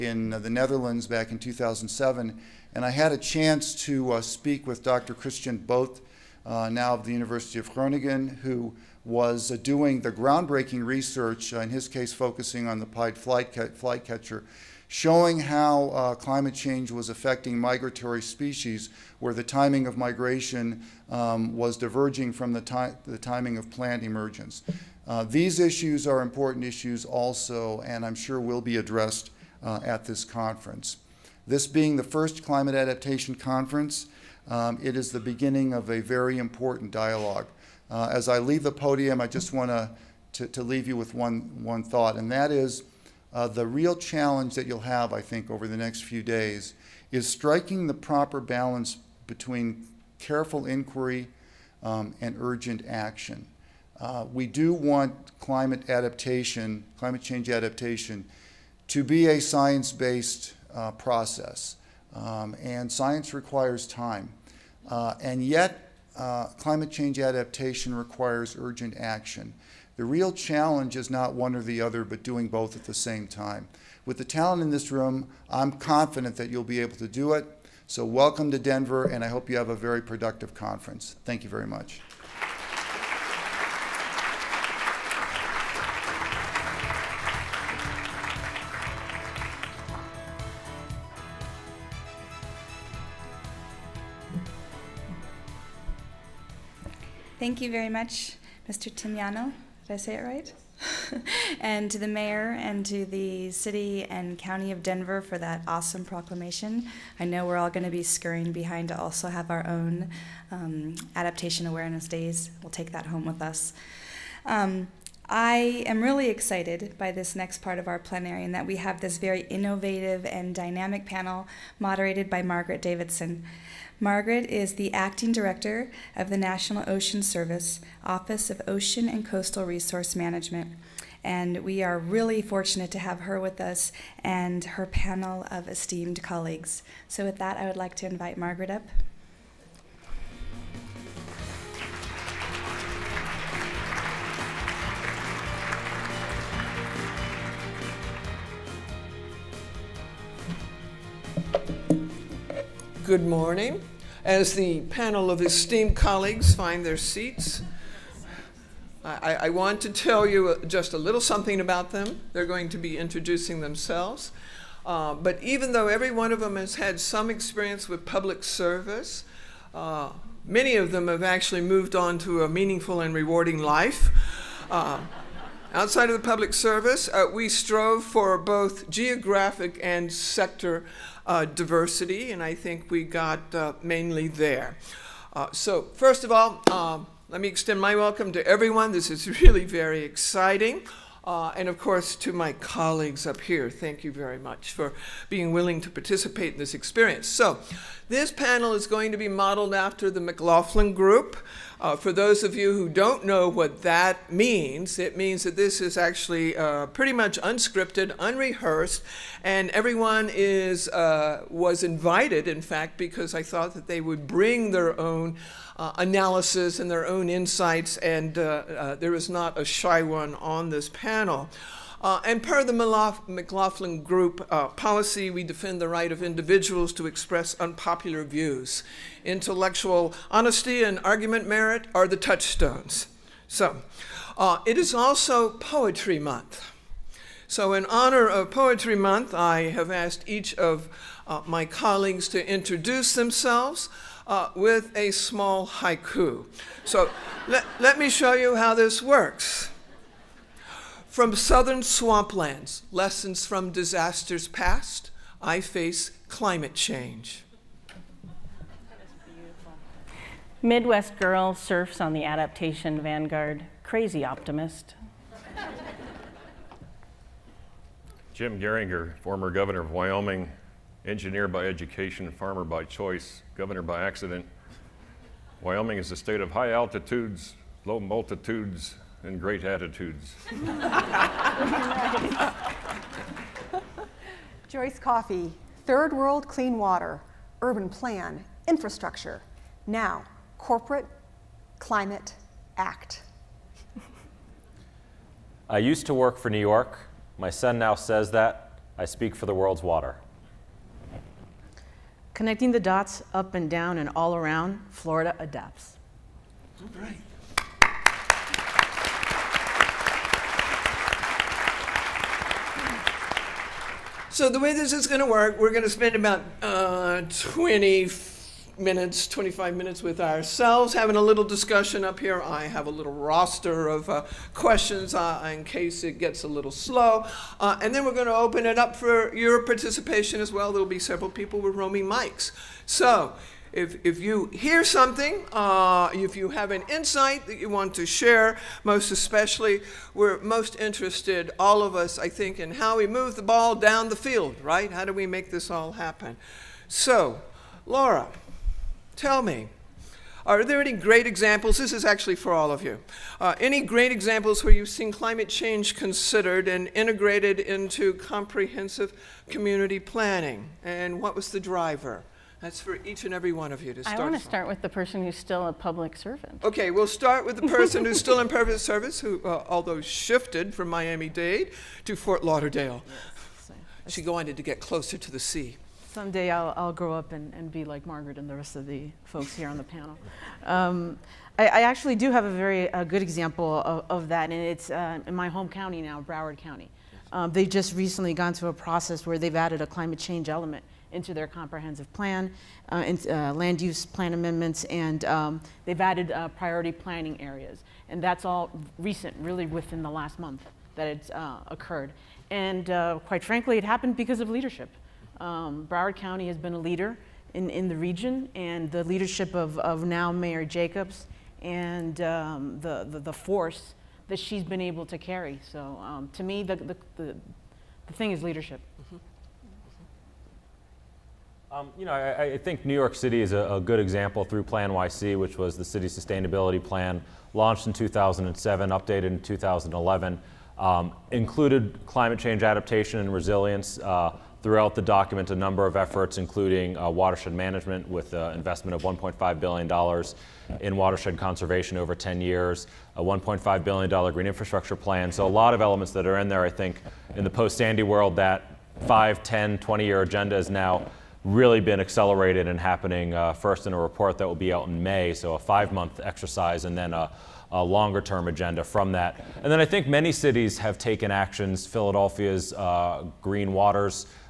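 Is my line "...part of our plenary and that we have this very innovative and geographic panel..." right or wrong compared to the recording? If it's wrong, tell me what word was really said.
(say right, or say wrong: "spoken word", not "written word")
wrong: "dynamic", not "geographic".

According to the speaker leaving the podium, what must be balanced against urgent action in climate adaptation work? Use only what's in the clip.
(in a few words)
careful inquiry.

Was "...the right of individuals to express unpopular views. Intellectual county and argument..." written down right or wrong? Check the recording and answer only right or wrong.
wrong.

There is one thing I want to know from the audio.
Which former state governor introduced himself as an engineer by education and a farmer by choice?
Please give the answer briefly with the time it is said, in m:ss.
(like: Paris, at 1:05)
Jim Geringer, at 4:28.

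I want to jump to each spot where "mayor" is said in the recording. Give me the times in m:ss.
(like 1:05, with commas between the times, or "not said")
1:42, 6:50.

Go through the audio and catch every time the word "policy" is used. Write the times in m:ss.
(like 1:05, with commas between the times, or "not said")
3:44.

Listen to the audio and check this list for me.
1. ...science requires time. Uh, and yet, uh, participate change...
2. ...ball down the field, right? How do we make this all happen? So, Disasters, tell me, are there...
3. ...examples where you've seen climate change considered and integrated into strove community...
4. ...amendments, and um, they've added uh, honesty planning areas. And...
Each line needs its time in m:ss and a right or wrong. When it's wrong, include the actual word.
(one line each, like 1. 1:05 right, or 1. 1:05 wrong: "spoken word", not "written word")
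1. 1:02 wrong: "climate", not "participate"
2. 5:43 wrong: "Laura", not "Disasters"
3. 5:54 wrong: "comprehensive", not "strove"
4. 6:34 wrong: "priority", not "honesty".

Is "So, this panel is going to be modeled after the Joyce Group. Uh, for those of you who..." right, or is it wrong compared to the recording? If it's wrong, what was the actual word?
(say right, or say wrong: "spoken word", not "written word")
wrong: "McLaughlin", not "Joyce".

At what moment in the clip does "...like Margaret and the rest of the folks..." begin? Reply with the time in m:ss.
6:17.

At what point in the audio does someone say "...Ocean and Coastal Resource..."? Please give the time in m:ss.
2:08.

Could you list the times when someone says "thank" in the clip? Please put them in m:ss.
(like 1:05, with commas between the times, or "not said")
1:21, 1:37, 3:13.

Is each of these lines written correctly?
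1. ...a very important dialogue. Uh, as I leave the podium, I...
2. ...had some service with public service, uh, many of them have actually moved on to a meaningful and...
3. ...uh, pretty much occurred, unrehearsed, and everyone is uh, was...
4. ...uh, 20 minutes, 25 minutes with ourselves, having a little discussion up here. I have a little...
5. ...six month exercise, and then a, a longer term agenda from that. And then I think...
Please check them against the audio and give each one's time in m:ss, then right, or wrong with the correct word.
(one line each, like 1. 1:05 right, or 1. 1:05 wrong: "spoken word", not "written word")
1. 0:35 right
2. 2:46 wrong: "experience", not "service"
3. 3:26 wrong: "unscripted", not "occurred"
4. 5:16 right
5. 7:35 wrong: "five", not "six".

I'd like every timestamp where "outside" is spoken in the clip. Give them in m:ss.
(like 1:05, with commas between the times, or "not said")
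2:55.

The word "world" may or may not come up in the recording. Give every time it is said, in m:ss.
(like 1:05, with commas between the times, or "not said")
4:46, 4:59, 7:28.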